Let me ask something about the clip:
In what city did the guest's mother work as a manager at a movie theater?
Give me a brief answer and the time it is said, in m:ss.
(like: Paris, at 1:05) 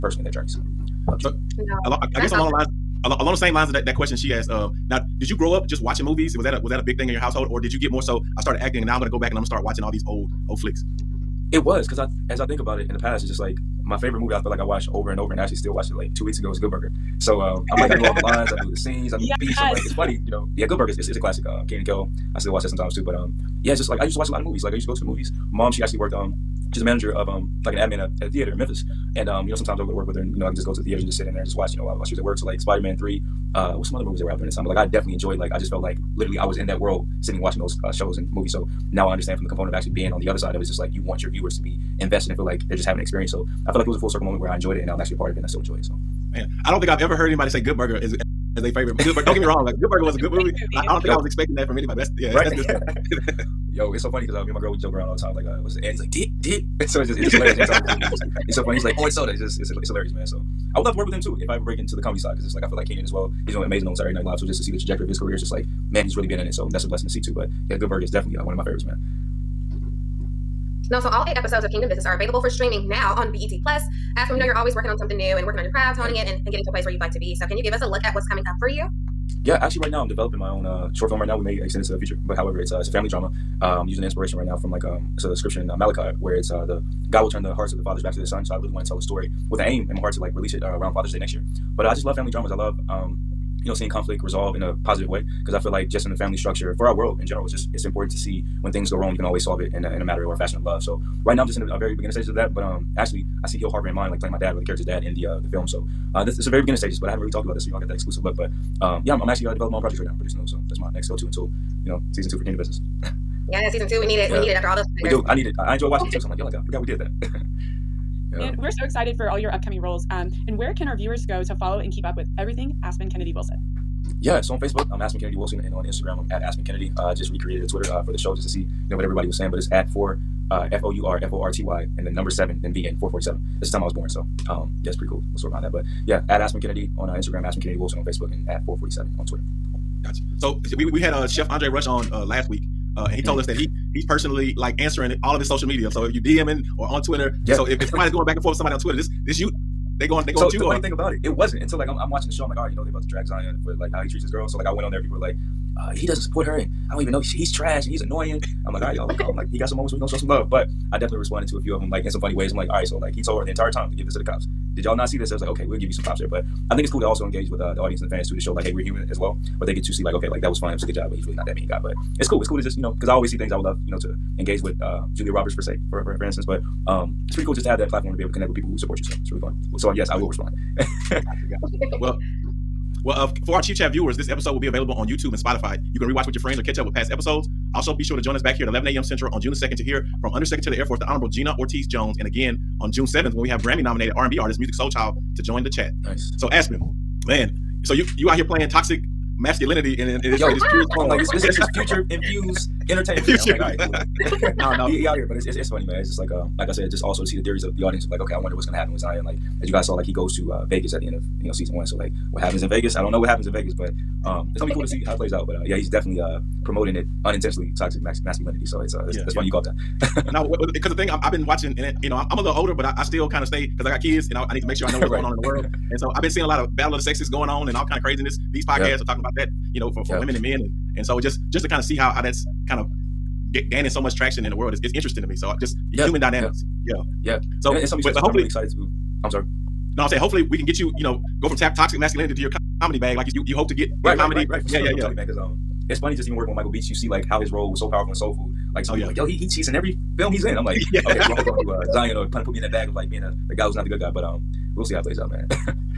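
Memphis, at 0:28.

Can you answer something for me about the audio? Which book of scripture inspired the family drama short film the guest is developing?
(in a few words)
Malachi.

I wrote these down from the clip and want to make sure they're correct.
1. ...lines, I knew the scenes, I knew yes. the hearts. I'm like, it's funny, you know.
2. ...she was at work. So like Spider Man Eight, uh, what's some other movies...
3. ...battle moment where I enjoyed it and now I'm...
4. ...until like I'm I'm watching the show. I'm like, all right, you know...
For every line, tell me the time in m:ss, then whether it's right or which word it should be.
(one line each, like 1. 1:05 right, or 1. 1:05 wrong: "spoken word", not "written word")
1. 0:18 wrong: "beats", not "hearts"
2. 0:32 wrong: "Three", not "Eight"
3. 0:44 wrong: "circle", not "battle"
4. 2:31 right.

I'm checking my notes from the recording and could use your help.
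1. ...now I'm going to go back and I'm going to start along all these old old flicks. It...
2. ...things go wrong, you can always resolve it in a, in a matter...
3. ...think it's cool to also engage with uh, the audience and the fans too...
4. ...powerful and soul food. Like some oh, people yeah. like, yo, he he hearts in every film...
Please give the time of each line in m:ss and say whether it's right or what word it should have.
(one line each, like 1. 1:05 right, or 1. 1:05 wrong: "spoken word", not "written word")
1. 0:08 wrong: "watching", not "along"
2. 1:38 wrong: "solve", not "resolve"
3. 2:46 right
4. 4:07 wrong: "cheats", not "hearts".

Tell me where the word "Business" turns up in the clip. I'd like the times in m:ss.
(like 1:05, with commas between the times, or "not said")
1:11, 1:52.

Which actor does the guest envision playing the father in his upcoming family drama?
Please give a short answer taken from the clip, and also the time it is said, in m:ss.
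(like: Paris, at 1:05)
Hill Harper, at 1:43.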